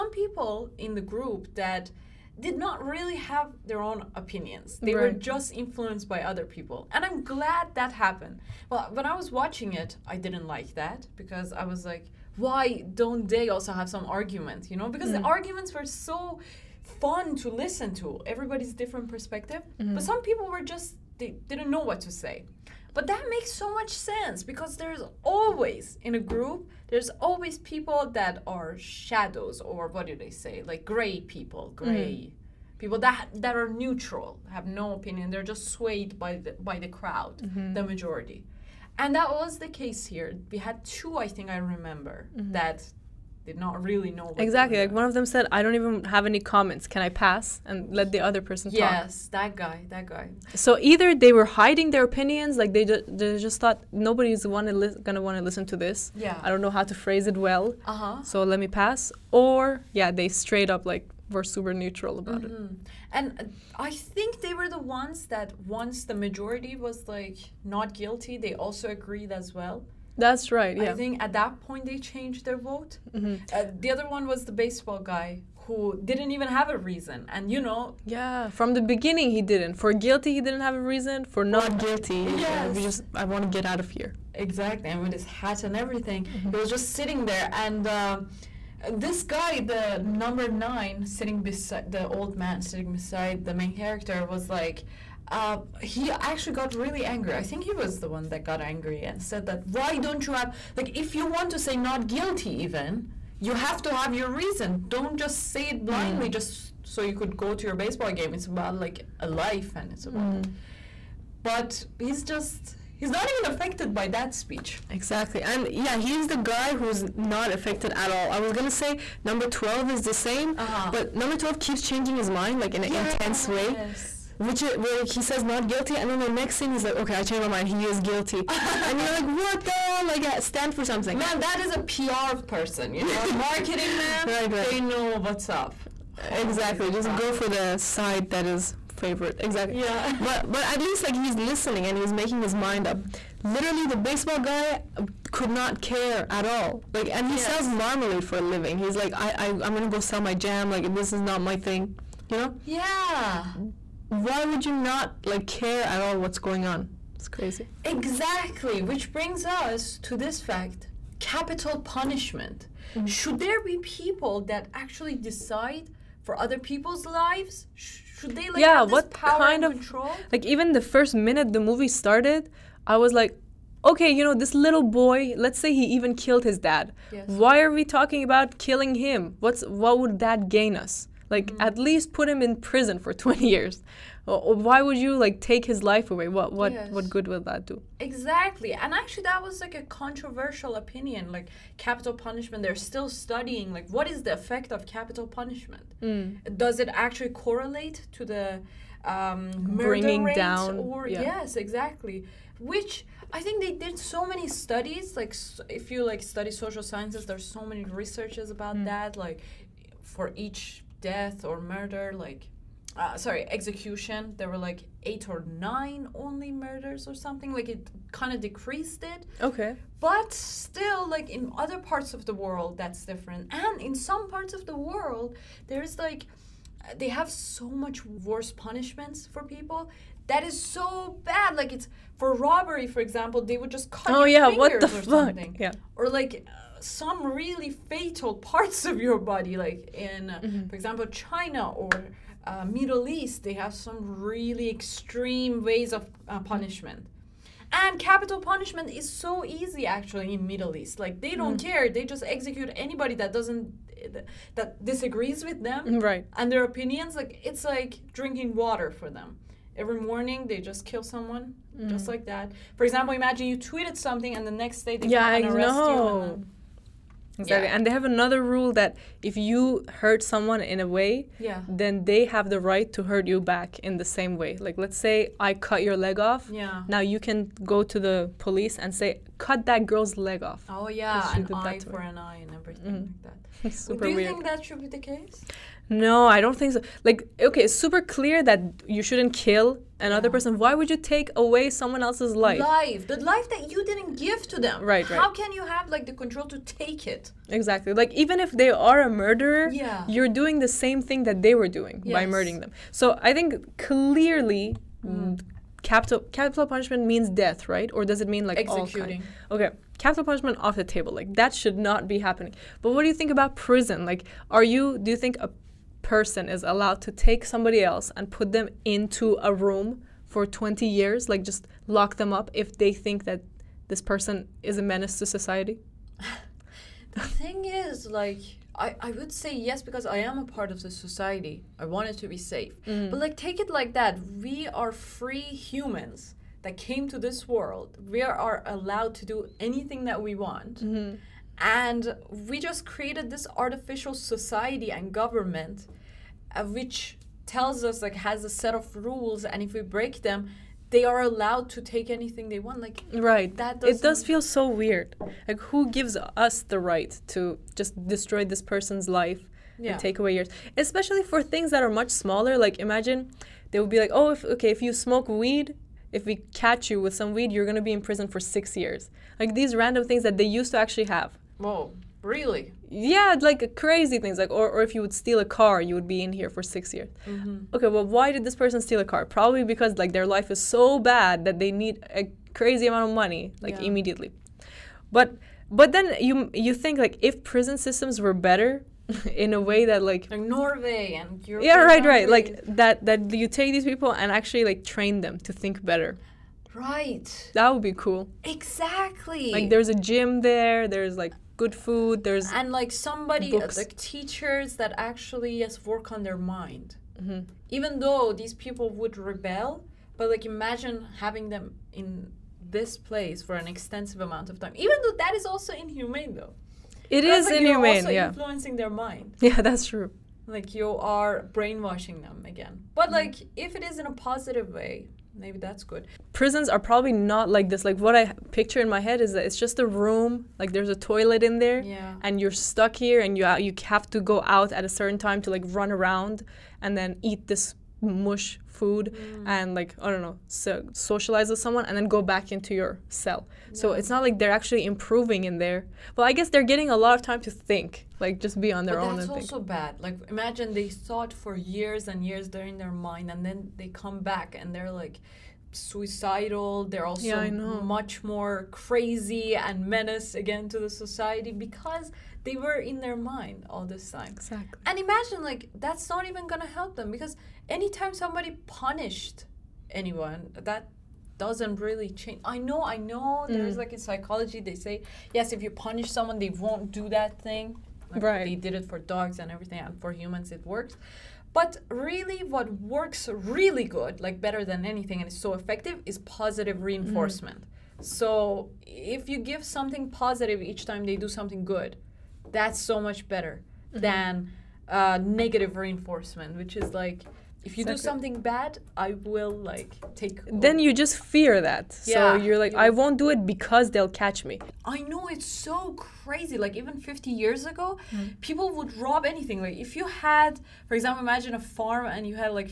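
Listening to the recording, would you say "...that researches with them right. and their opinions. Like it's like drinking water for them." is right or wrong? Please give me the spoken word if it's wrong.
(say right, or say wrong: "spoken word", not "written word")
wrong: "disagrees", not "researches".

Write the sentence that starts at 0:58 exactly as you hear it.
so let me pass or yeah they straight up like were super neutral about mm-hmm.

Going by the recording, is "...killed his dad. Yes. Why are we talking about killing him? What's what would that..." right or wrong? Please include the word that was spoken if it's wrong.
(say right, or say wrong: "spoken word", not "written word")
right.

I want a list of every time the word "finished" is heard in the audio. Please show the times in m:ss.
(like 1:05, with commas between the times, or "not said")
not said.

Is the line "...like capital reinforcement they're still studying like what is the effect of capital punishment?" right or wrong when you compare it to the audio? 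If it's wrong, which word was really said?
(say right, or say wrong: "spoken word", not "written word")
wrong: "punishment", not "reinforcement".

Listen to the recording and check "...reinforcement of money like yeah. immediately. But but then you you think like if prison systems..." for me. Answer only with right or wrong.
wrong.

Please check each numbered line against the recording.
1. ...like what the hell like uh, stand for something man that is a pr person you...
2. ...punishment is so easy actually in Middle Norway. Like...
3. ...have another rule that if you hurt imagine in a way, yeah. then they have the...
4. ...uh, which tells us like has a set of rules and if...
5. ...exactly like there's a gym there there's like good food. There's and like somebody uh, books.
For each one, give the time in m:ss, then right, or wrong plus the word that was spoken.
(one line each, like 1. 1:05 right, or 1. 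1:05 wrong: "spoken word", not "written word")
1. 2:09 right
2. 4:08 wrong: "East", not "Norway"
3. 4:27 wrong: "someone", not "imagine"
4. 5:46 right
5. 6:38 right.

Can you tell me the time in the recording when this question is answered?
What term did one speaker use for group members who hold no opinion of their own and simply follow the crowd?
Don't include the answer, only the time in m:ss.
0:30.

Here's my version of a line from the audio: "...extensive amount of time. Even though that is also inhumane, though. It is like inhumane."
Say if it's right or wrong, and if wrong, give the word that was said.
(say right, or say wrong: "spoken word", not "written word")
right.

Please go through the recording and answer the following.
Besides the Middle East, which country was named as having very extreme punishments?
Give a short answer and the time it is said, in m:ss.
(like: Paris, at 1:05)
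China, at 4:01.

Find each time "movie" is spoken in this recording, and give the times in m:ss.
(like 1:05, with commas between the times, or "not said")
2:51.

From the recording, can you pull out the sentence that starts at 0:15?
the arguments were so fun to listen to.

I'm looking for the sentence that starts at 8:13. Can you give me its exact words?
than uh, negative reinforcement, which is like if you do something bad, I will like take.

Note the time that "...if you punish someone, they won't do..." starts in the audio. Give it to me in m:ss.
7:55.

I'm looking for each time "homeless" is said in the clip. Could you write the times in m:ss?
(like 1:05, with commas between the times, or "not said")
not said.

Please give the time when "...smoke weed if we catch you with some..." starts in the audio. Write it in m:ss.
6:04.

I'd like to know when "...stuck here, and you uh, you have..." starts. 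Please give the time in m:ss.
7:12.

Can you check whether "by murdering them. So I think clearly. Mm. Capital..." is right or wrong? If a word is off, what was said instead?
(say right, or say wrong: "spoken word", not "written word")
right.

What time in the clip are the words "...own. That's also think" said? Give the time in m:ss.
7:29.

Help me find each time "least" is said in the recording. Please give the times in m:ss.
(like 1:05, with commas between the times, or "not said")
2:20, 3:01.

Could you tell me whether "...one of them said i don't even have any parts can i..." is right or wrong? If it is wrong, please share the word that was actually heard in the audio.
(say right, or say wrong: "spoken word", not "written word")
wrong: "comments", not "parts".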